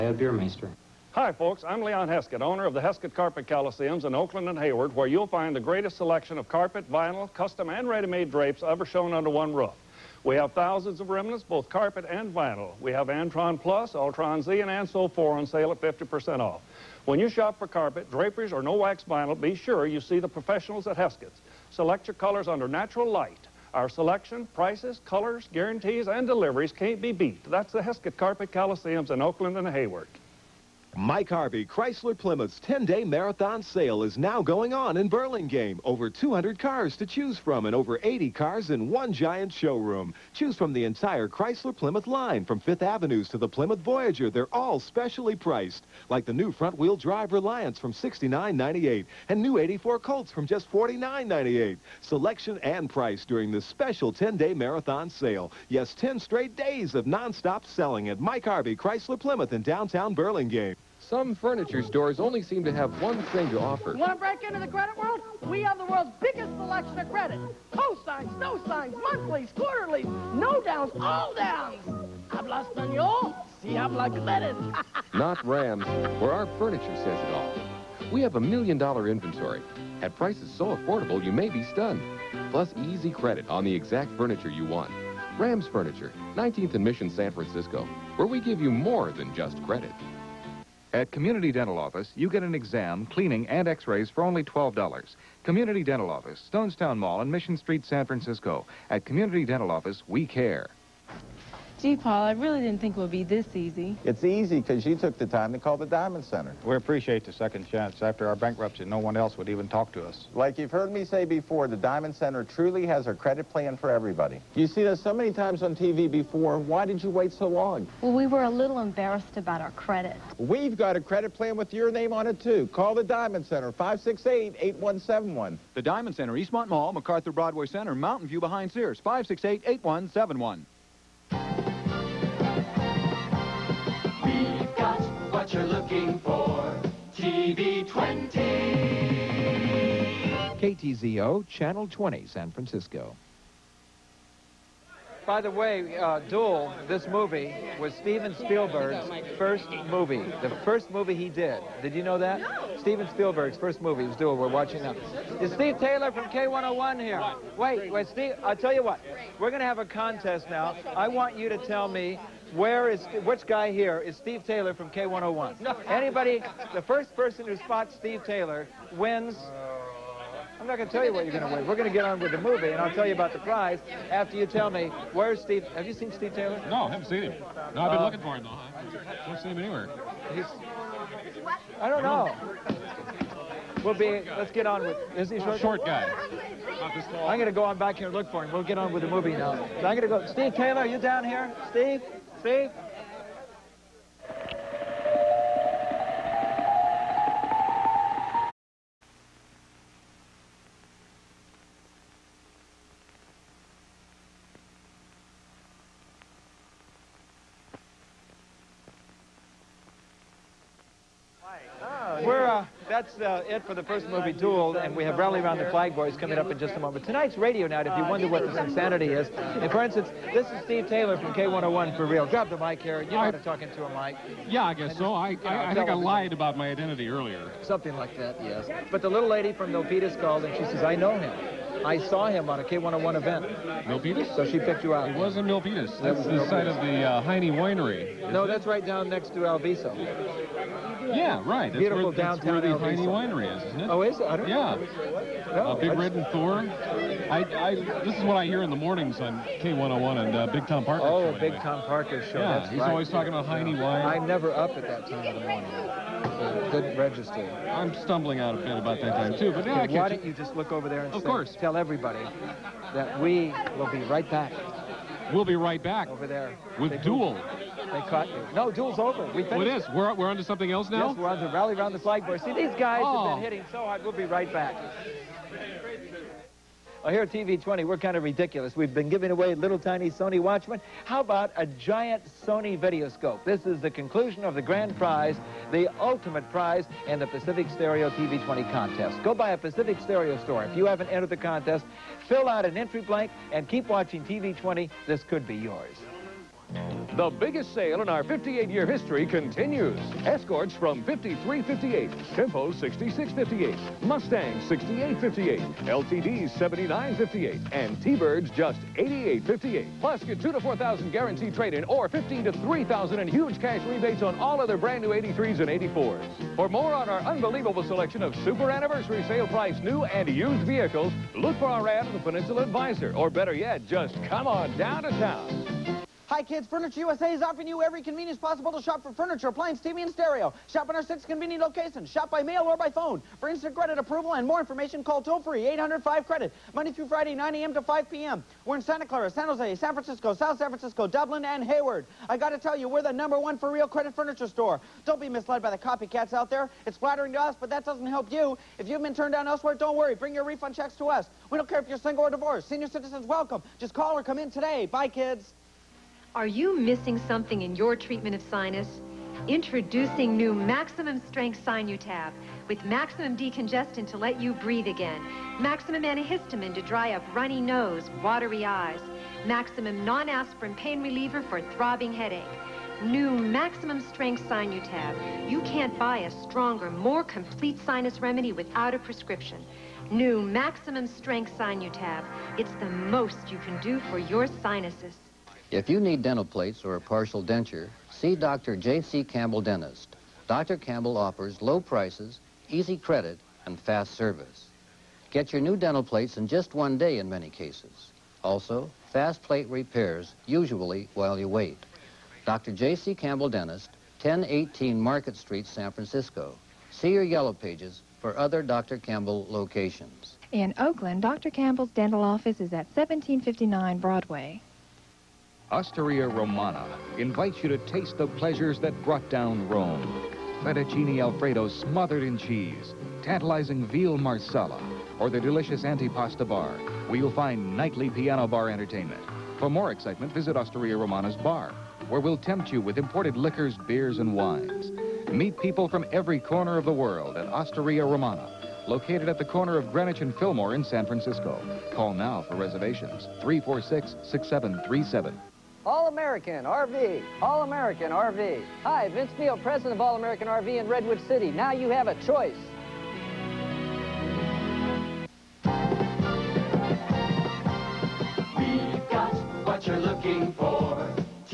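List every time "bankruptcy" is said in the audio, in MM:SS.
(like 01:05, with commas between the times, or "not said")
01:48.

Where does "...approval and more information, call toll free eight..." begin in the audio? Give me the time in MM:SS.
05:33.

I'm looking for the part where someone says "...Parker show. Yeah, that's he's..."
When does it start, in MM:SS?
04:11.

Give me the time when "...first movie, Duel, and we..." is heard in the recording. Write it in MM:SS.
03:33.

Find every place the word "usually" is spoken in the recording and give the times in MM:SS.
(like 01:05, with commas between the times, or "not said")
06:40.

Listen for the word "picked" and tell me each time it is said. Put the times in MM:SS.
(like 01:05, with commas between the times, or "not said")
03:54.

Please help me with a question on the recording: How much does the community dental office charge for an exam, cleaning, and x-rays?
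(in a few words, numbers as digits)
$12.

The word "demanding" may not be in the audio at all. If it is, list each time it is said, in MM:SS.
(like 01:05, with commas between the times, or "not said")
not said.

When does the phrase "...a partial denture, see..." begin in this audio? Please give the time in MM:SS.
06:26.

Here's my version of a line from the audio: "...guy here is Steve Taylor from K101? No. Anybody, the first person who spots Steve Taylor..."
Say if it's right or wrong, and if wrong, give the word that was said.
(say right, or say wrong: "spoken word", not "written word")
right.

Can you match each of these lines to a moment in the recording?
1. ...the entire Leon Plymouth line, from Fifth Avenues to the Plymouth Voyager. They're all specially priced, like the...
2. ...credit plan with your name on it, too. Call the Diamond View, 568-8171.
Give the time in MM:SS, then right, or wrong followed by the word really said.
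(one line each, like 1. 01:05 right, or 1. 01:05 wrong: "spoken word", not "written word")
1. 00:40 wrong: "Chrysler", not "Leon"
2. 02:01 wrong: "Center", not "View".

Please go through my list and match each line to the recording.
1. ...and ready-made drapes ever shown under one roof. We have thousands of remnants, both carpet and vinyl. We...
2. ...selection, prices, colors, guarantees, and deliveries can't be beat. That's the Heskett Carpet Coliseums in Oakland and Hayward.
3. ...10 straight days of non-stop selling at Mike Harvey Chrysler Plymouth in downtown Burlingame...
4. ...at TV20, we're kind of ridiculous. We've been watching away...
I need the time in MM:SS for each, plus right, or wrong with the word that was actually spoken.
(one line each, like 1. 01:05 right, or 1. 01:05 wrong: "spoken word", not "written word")
1. 00:07 right
2. 00:23 right
3. 00:55 right
4. 04:37 wrong: "giving", not "watching".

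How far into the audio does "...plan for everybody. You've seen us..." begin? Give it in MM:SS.
01:53.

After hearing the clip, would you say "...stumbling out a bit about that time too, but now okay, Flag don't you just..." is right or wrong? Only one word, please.
wrong.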